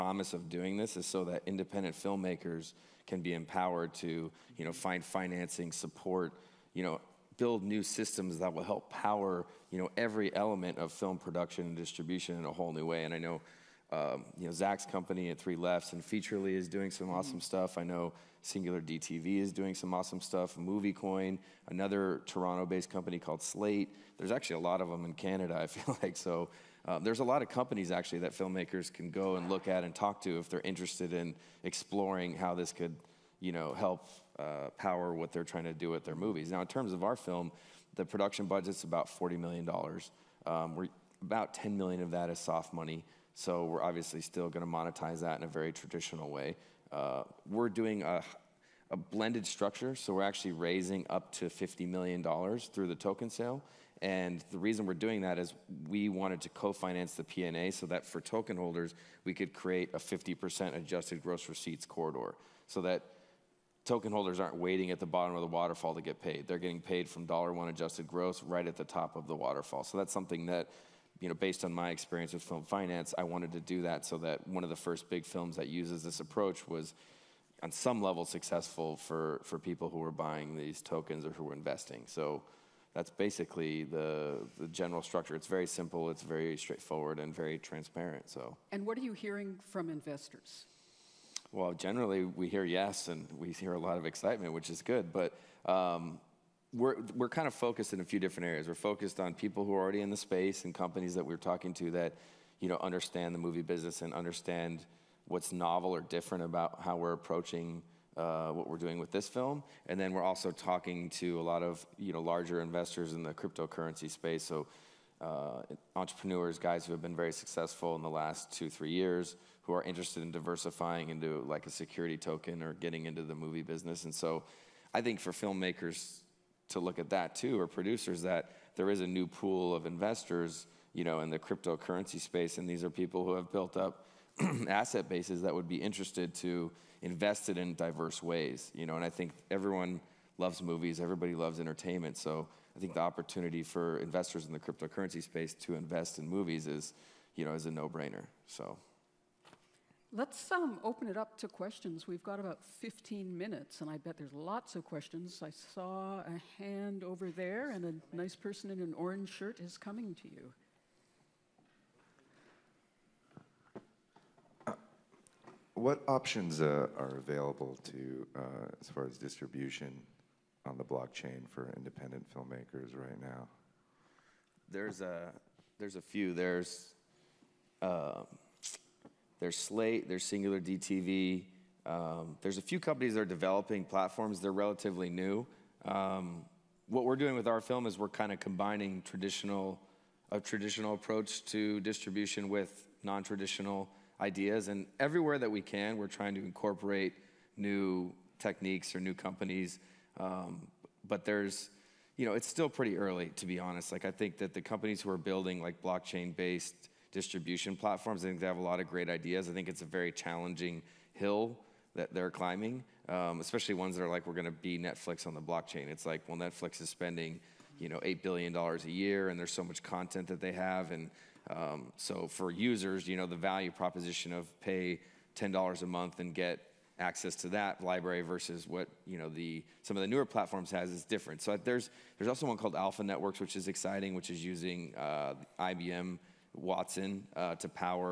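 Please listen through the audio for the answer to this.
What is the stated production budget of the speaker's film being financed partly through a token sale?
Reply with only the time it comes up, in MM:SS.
00:39.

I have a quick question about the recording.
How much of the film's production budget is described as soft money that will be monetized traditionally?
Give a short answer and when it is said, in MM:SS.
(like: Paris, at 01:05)
10 million, at 00:41.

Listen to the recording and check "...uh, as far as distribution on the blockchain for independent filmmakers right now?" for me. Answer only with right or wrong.
right.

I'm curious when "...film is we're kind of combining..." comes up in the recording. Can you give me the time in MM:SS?
03:07.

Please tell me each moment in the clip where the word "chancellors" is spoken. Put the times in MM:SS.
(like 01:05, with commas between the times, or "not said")
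not said.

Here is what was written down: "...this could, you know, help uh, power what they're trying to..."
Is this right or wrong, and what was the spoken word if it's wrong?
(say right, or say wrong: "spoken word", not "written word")
right.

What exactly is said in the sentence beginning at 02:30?
Let's um, open it up to questions.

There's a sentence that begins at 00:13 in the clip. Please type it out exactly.
And I know, um, you know, Zac's company at Three Lefts and Featurely is doing some mm-hmm.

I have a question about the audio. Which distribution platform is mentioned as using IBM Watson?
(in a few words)
Alpha Networks.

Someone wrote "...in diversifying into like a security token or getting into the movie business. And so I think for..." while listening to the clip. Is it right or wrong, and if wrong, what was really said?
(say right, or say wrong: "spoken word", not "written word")
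right.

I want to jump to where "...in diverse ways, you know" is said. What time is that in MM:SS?
02:17.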